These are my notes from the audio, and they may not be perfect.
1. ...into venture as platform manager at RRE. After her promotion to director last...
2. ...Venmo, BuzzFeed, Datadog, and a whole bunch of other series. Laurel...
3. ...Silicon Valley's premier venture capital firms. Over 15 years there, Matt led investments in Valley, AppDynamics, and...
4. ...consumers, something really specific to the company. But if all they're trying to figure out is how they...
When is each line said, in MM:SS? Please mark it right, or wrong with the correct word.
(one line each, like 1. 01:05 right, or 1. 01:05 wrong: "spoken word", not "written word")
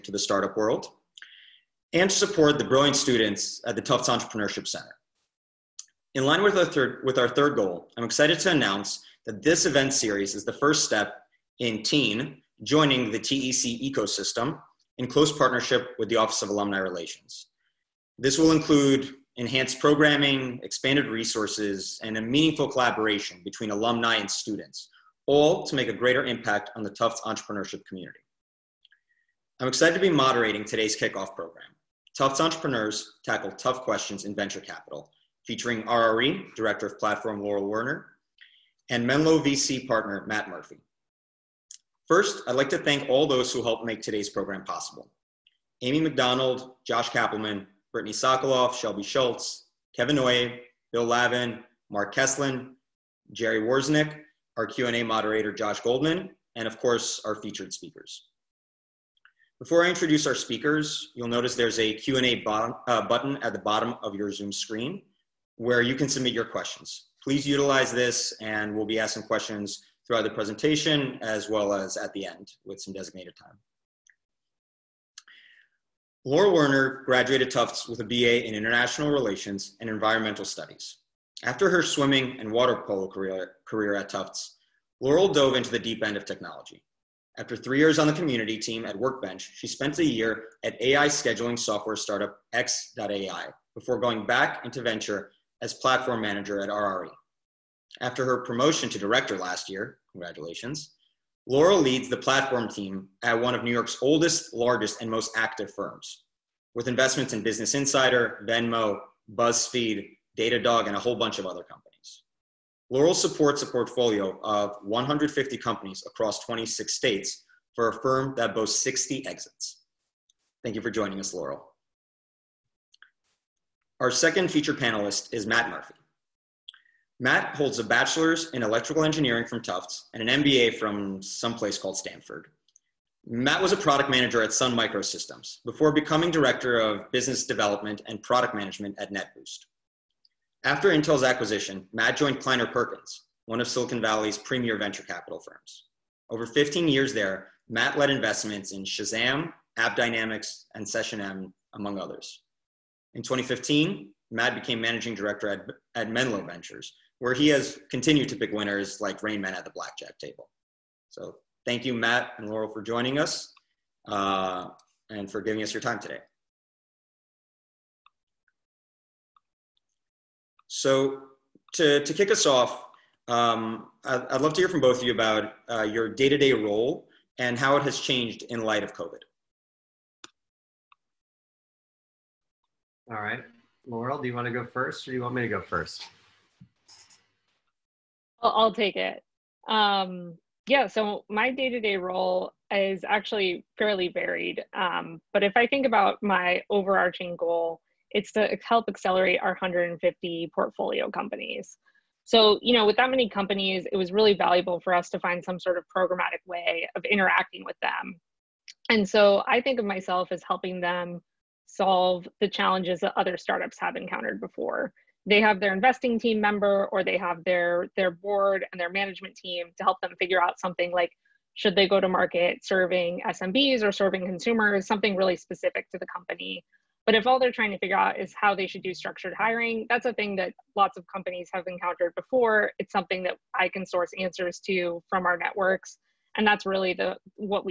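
1. 01:34 right
2. 01:48 wrong: "companies", not "series"
3. 02:23 wrong: "Shazam", not "Valley"
4. 03:44 right.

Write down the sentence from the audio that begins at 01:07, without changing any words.
Please utilize this and we'll be asking questions throughout the presentation as well as at the end with some designated time.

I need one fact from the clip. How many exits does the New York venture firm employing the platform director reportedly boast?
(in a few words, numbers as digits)
60.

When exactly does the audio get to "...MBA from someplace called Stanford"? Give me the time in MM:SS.
02:10.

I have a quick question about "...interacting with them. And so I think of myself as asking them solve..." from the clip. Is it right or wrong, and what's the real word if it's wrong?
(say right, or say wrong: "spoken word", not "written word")
wrong: "helping", not "asking".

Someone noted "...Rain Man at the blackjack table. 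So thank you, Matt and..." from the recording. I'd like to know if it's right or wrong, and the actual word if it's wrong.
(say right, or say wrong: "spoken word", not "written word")
right.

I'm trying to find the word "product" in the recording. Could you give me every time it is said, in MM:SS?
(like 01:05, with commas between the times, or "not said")
02:13, 02:18.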